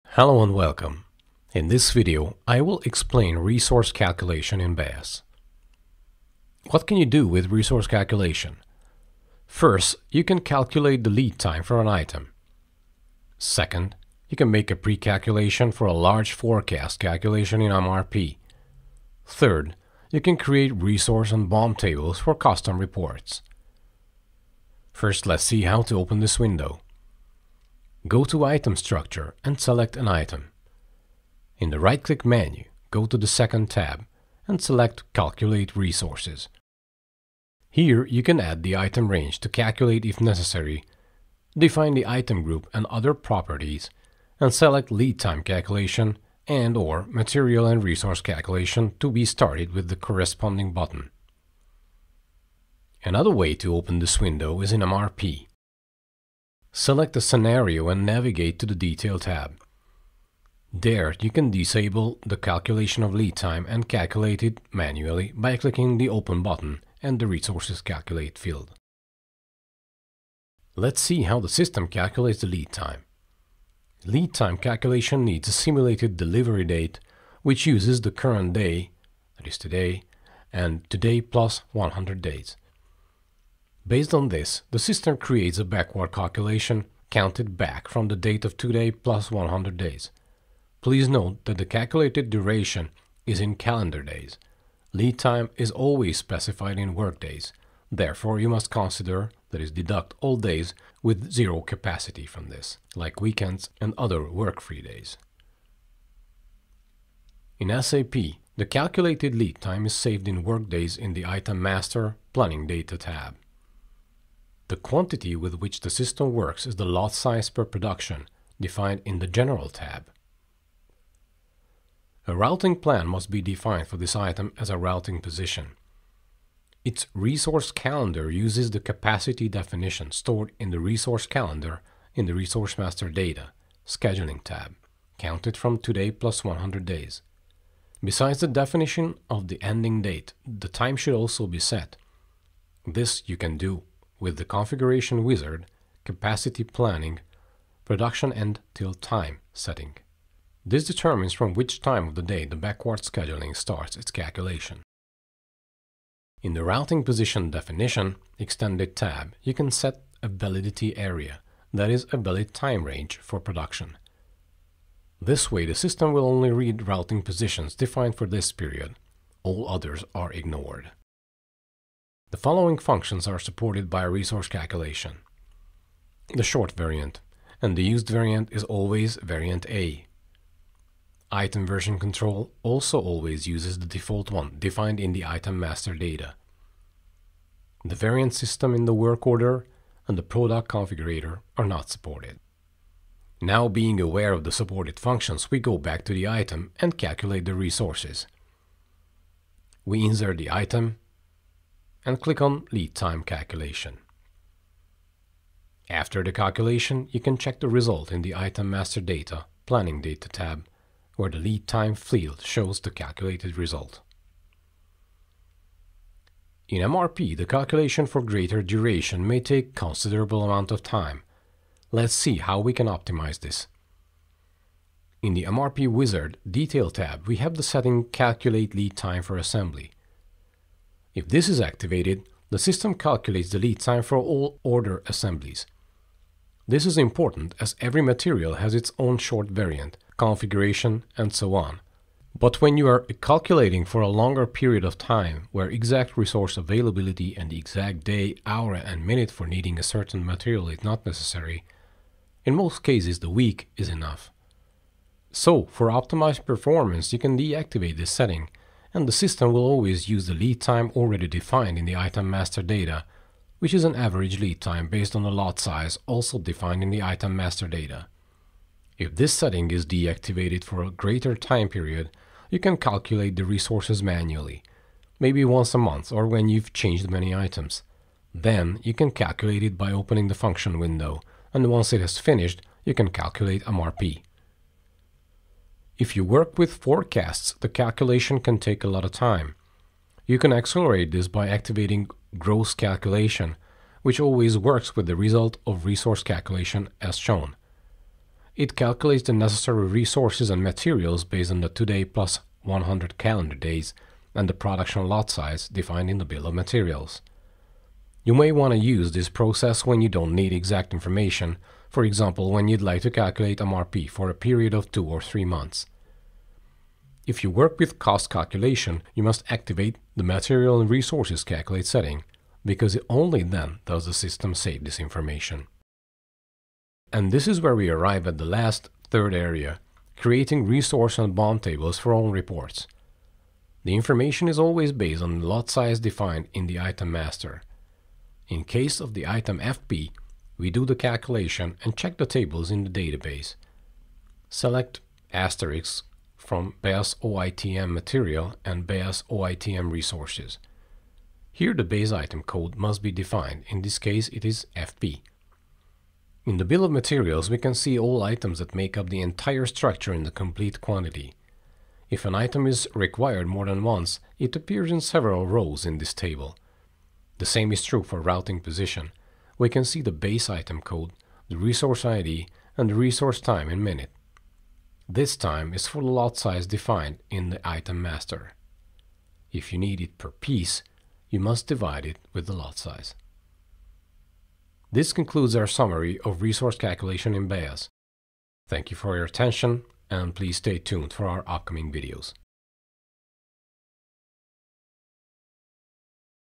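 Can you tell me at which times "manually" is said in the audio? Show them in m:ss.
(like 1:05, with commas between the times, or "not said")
1:04, 4:34.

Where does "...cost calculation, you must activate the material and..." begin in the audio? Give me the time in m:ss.
5:17.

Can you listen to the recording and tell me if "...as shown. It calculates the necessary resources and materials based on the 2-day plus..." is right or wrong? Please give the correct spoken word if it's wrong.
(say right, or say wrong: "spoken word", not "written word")
right.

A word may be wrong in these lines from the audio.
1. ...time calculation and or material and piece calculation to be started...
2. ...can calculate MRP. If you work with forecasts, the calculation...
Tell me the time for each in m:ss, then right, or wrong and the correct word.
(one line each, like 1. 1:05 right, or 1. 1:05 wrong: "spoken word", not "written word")
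1. 0:45 wrong: "resource", not "piece"
2. 4:42 right.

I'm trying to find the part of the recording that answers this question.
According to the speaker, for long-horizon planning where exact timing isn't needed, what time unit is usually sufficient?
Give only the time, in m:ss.
4:13.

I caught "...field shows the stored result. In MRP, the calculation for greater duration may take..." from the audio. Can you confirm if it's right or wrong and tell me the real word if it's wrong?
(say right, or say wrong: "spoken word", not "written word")
wrong: "calculated", not "stored".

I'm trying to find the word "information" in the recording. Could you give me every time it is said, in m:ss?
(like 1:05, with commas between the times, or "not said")
5:10, 5:24, 5:33.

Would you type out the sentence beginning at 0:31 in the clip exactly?
In the right-click menu, go to the second tab and select Calculate Resources.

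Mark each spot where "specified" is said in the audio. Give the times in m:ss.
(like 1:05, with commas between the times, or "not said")
1:36.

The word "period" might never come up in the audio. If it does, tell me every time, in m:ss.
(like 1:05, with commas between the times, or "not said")
2:48, 4:04, 4:31, 5:14.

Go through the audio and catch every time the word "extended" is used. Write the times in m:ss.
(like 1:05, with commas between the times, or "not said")
2:38.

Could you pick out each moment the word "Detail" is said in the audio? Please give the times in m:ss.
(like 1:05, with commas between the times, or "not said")
0:58, 3:46.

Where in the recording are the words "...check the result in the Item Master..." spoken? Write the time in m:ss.
3:27.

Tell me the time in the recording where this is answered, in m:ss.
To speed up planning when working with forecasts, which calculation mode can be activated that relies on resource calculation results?
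4:52.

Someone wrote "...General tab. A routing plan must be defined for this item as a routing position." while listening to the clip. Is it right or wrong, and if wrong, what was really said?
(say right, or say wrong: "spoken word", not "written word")
right.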